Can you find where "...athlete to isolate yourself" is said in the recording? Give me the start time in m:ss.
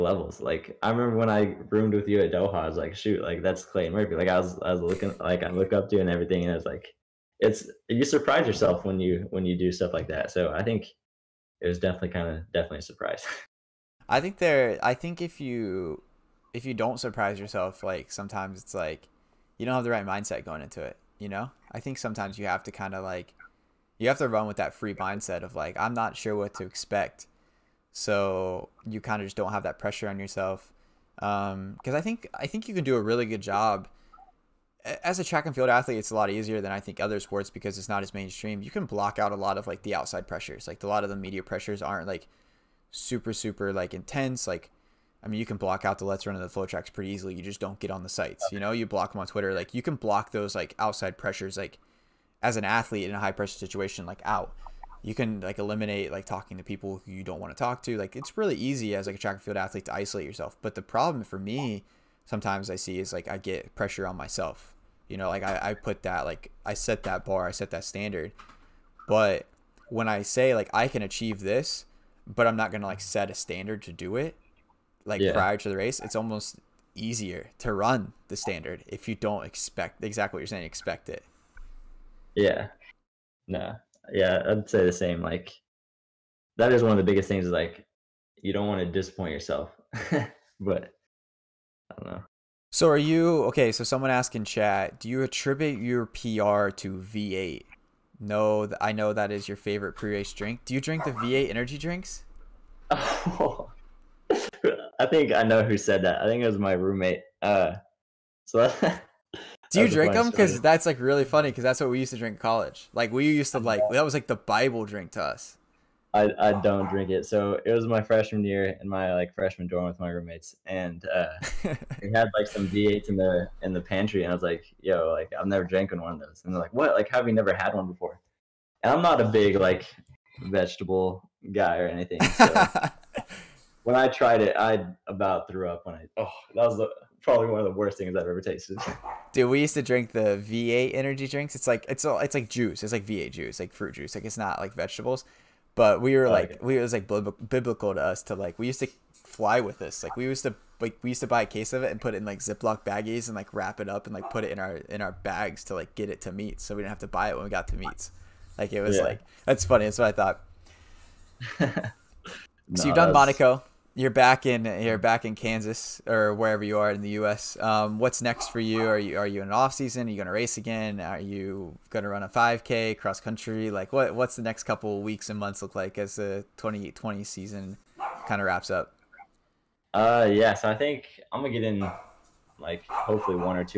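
0:59.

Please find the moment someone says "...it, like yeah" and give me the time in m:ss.
1:14.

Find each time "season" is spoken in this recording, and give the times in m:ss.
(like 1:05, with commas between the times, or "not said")
2:49, 2:57.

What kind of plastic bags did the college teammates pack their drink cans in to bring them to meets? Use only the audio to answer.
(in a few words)
Ziploc baggies.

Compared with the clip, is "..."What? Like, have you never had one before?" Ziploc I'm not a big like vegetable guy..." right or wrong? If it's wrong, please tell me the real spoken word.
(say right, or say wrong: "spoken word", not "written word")
wrong: "And", not "Ziploc".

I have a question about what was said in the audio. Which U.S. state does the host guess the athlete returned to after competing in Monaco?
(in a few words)
Kansas.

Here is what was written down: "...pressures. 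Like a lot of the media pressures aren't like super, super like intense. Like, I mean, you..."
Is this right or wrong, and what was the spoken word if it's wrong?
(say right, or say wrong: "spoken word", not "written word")
right.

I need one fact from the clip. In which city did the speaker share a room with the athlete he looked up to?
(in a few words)
Doha.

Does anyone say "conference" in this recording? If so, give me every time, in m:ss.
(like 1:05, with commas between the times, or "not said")
not said.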